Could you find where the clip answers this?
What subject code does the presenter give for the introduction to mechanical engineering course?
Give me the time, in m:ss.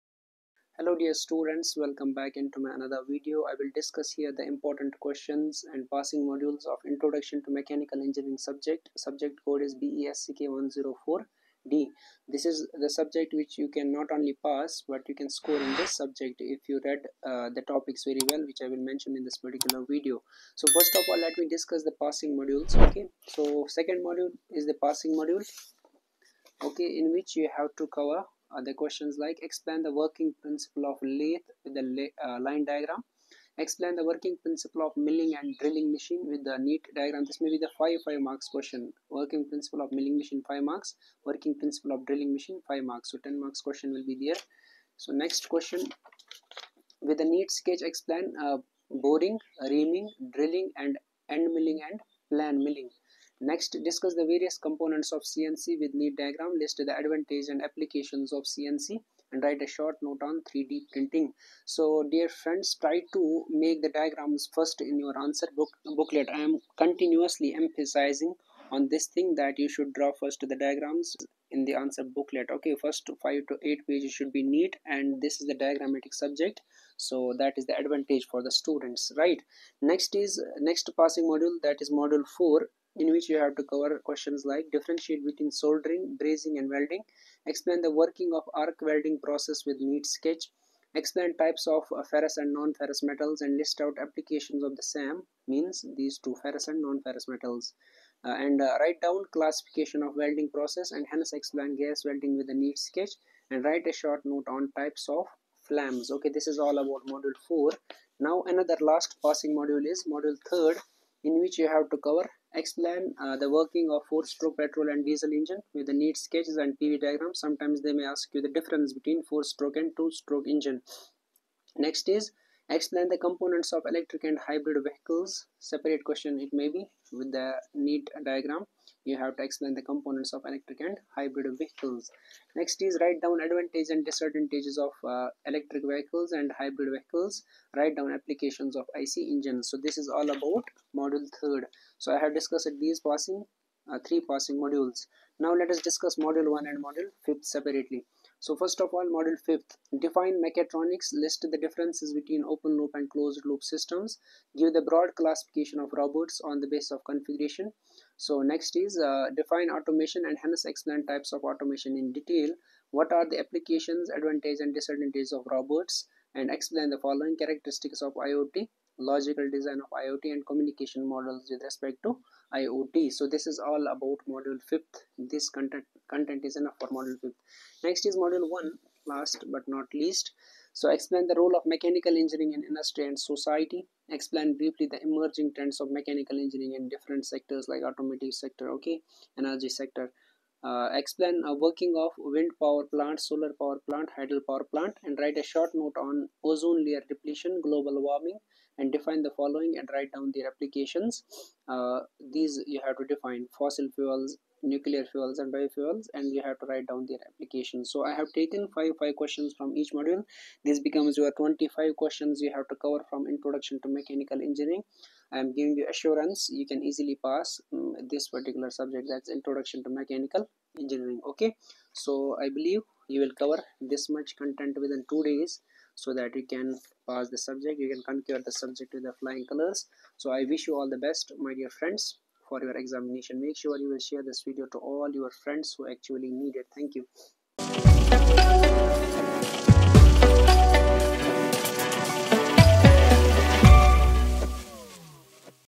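0:09.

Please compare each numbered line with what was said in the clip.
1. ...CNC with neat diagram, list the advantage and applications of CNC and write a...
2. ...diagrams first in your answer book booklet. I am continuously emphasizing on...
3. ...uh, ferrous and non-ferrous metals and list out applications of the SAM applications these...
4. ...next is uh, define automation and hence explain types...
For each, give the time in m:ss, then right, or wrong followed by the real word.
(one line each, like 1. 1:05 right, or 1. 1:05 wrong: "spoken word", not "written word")
1. 0:55 right
2. 1:03 right
3. 1:31 wrong: "means", not "applications"
4. 2:38 right.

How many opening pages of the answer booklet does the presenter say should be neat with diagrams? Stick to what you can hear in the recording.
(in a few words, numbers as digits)
5 to 8.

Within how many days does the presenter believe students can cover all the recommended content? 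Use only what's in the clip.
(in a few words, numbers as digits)
2.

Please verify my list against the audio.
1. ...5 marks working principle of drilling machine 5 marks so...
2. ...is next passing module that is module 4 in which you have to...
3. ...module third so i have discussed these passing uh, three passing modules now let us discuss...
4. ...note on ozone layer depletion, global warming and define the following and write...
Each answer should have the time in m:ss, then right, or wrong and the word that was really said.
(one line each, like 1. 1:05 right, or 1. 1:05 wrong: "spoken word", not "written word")
1. 0:40 right
2. 1:20 right
3. 2:20 right
4. 3:15 right.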